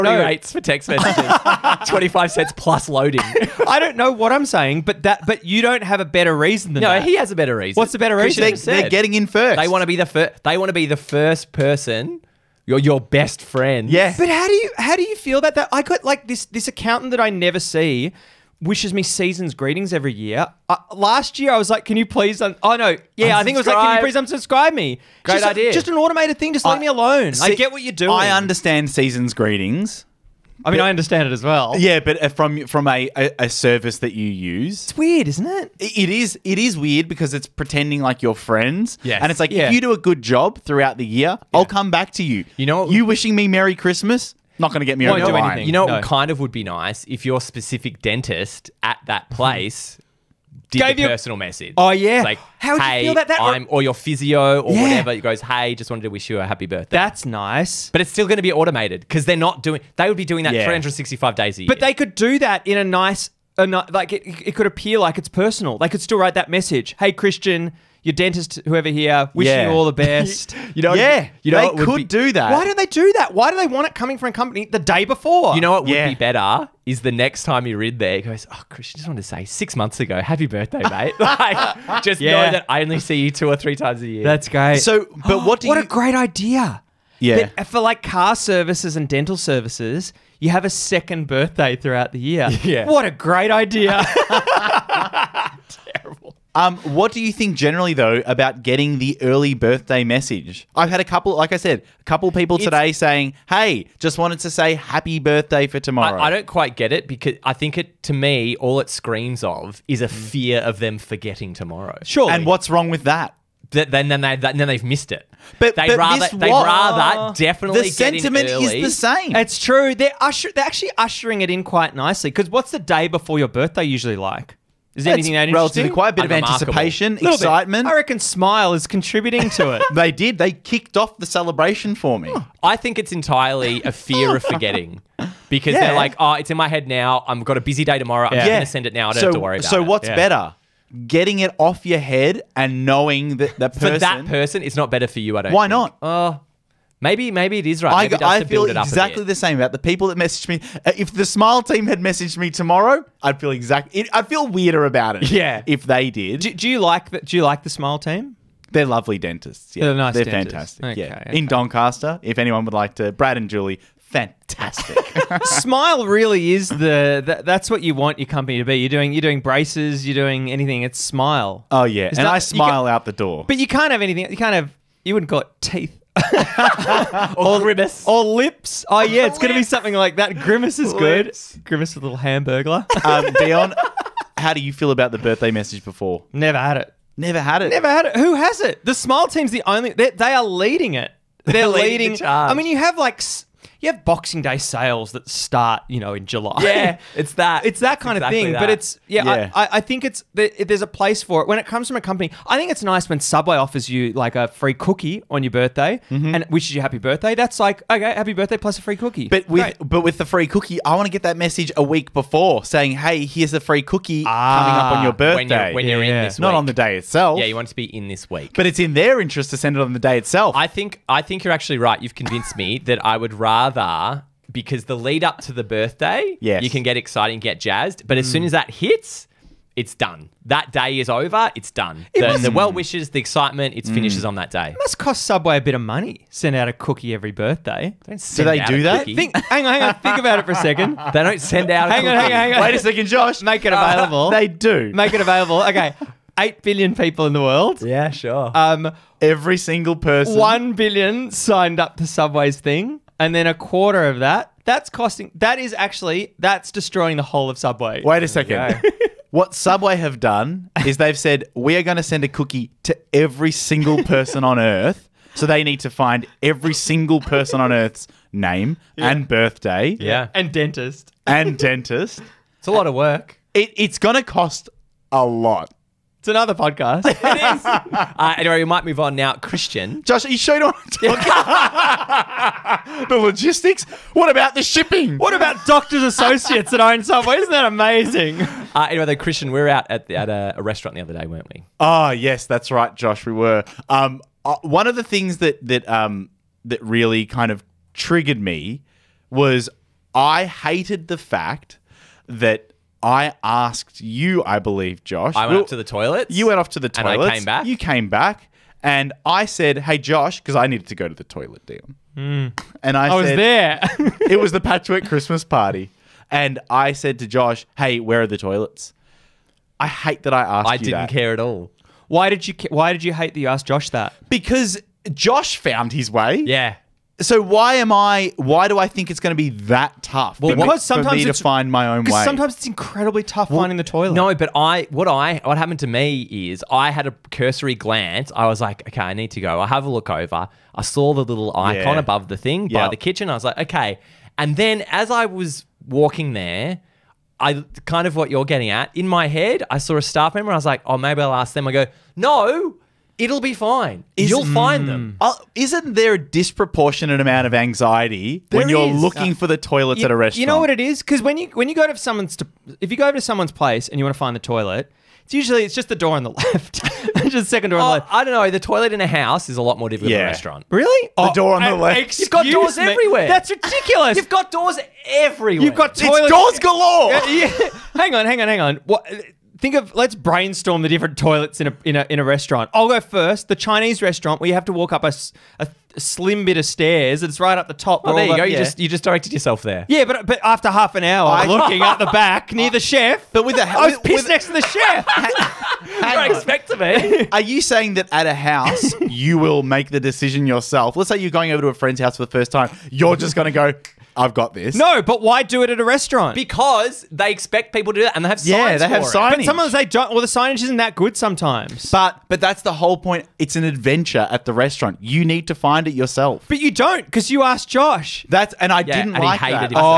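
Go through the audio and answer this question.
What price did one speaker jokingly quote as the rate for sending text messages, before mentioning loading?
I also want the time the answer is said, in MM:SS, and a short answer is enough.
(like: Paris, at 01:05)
25 cents, at 00:01.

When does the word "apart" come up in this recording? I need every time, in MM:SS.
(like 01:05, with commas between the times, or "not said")
not said.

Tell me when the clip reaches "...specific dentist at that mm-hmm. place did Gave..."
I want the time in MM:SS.
00:47.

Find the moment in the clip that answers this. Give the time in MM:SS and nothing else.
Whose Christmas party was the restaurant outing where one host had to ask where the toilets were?
05:14.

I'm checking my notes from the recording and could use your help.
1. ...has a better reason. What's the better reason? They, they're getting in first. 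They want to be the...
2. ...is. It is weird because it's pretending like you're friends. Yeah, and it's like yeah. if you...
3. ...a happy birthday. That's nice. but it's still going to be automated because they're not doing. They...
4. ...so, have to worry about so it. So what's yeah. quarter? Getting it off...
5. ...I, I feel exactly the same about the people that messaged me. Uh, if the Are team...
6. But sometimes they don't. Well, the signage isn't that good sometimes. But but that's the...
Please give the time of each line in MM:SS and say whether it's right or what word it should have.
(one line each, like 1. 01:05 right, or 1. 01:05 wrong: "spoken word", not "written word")
1. 00:07 right
2. 00:36 right
3. 00:56 right
4. 02:19 wrong: "better", not "quarter"
5. 02:28 wrong: "Smile", not "Are"
6. 06:49 right.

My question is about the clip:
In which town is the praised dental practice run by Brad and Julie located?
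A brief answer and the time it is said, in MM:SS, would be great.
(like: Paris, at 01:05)
Doncaster, at 02:41.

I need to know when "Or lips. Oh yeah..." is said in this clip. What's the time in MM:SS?
02:58.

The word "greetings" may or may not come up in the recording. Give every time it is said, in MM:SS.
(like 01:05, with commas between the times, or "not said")
00:19, 00:29.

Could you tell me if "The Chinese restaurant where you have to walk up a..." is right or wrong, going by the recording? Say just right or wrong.
right.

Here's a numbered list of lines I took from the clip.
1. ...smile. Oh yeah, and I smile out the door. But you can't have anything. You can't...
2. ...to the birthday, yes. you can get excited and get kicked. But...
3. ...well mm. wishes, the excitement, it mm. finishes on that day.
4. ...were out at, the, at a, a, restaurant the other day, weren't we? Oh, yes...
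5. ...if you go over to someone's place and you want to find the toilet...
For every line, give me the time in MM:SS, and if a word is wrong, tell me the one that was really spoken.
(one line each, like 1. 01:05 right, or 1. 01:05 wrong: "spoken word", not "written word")
1. 02:50 right
2. 03:45 wrong: "jazzed", not "kicked"
3. 03:52 right
4. 04:49 right
5. 06:02 right.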